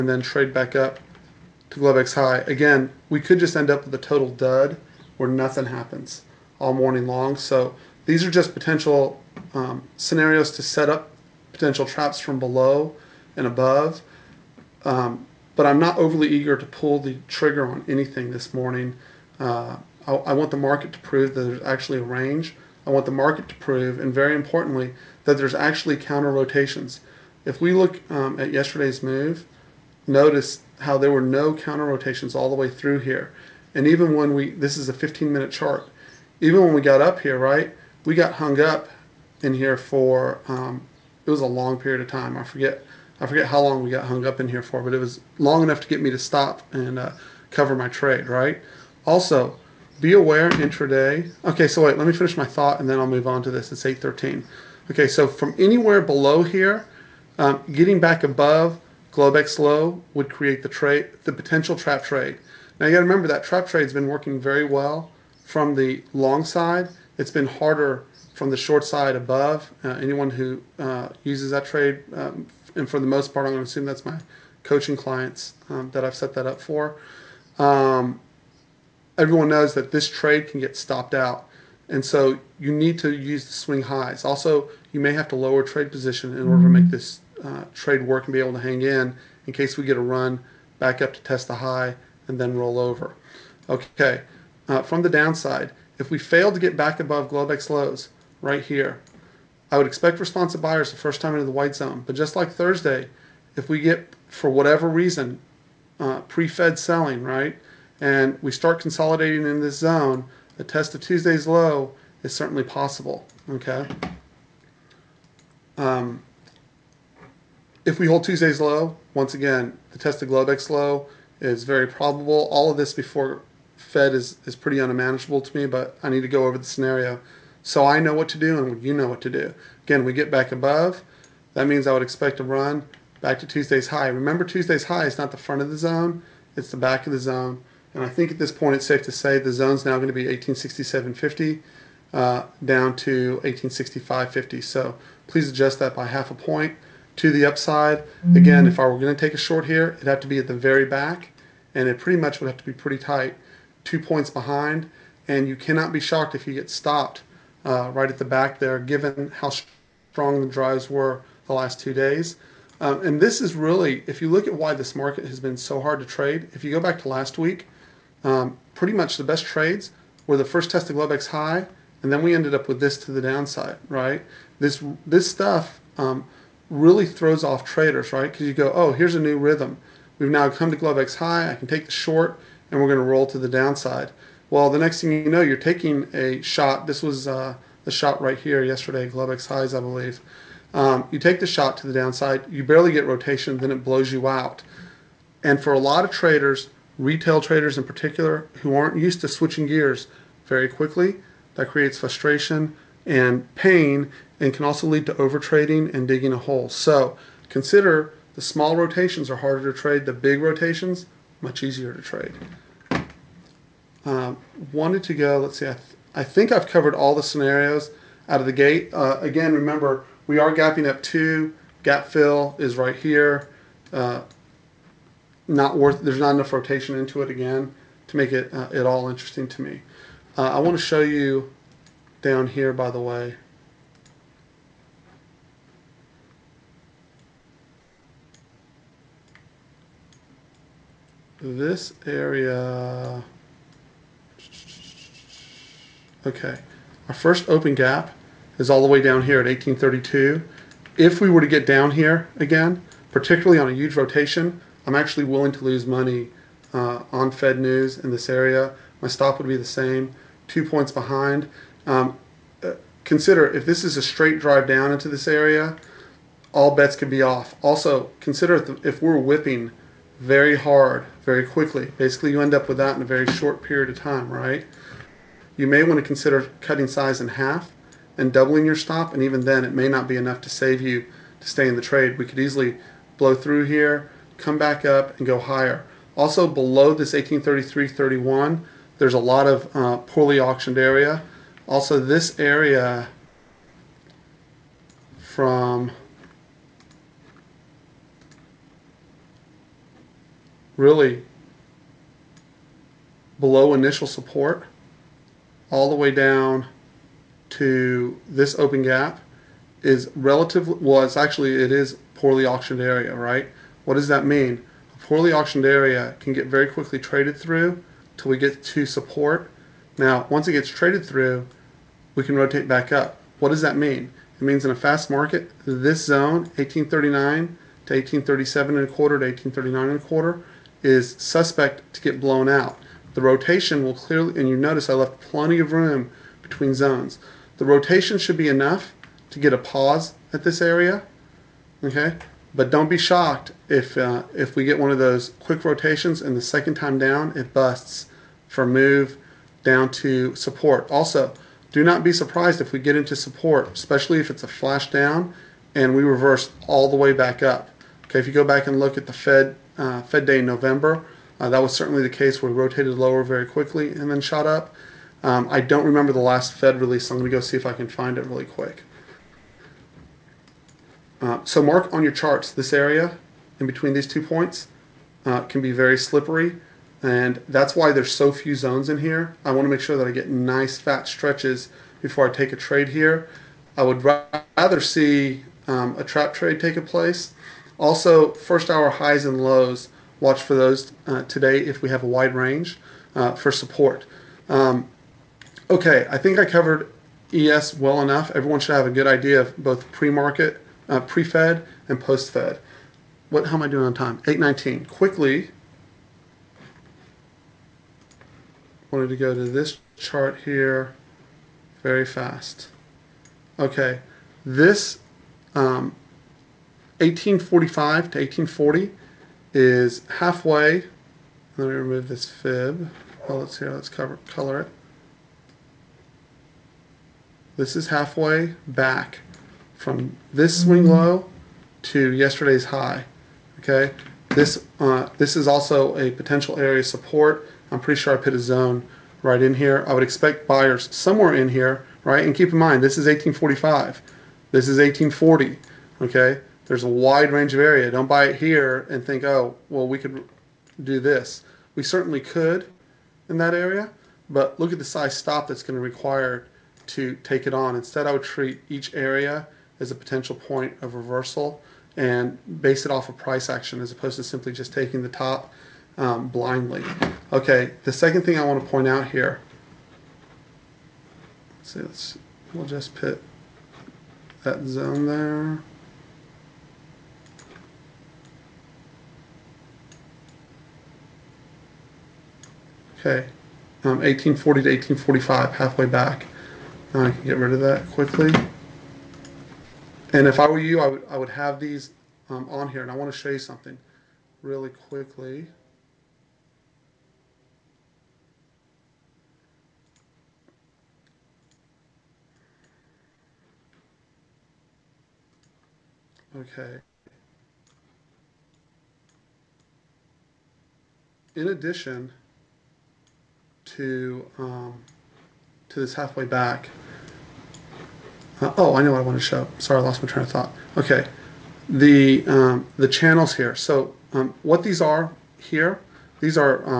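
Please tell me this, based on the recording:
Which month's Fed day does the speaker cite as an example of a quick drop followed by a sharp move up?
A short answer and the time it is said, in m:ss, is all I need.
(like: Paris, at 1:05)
November, at 6:00.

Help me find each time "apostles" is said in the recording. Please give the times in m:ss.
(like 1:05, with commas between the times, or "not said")
not said.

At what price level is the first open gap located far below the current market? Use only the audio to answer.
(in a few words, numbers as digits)
1832.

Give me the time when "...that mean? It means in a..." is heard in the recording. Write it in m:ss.
5:23.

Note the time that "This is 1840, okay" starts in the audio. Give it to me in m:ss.
7:24.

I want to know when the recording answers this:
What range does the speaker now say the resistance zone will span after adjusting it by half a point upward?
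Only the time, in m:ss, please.
2:20.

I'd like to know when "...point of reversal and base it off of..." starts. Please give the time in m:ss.
7:40.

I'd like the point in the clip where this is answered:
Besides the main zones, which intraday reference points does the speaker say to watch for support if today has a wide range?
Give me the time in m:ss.
6:28.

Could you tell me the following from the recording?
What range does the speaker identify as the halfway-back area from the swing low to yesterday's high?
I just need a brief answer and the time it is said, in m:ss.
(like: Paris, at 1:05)
1845 to 1840, at 6:56.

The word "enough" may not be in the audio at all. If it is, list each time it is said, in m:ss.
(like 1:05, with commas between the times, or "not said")
0:45, 3:46, 4:40, 5:38, 6:37.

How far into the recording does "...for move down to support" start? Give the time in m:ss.
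5:48.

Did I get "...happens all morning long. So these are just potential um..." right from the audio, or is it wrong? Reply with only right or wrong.
right.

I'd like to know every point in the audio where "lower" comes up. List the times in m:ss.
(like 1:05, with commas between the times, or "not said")
1:25, 6:02.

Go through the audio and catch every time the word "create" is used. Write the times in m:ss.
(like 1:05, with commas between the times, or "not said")
1:00, 3:21.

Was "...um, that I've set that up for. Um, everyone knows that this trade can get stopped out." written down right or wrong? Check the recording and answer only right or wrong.
right.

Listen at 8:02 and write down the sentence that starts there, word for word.
Okay, um, 1840 to 1845, halfway back.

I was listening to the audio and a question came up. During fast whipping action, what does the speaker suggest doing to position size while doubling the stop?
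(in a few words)
Cutting size in half.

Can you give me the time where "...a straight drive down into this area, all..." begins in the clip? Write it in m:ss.
4:23.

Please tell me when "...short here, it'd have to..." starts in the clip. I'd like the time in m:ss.
2:29.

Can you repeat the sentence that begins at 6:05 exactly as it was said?
Um, I don't remember the last Fed release, so I'm going to go see if I can find it really quick.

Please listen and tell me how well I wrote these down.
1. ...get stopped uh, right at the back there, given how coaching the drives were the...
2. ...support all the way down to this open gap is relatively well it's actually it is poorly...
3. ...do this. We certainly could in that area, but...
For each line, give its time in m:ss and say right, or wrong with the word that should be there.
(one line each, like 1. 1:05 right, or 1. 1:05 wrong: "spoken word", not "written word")
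1. 2:36 wrong: "strong", not "coaching"
2. 5:04 right
3. 7:30 right.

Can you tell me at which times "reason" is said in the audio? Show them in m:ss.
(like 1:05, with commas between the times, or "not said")
1:44.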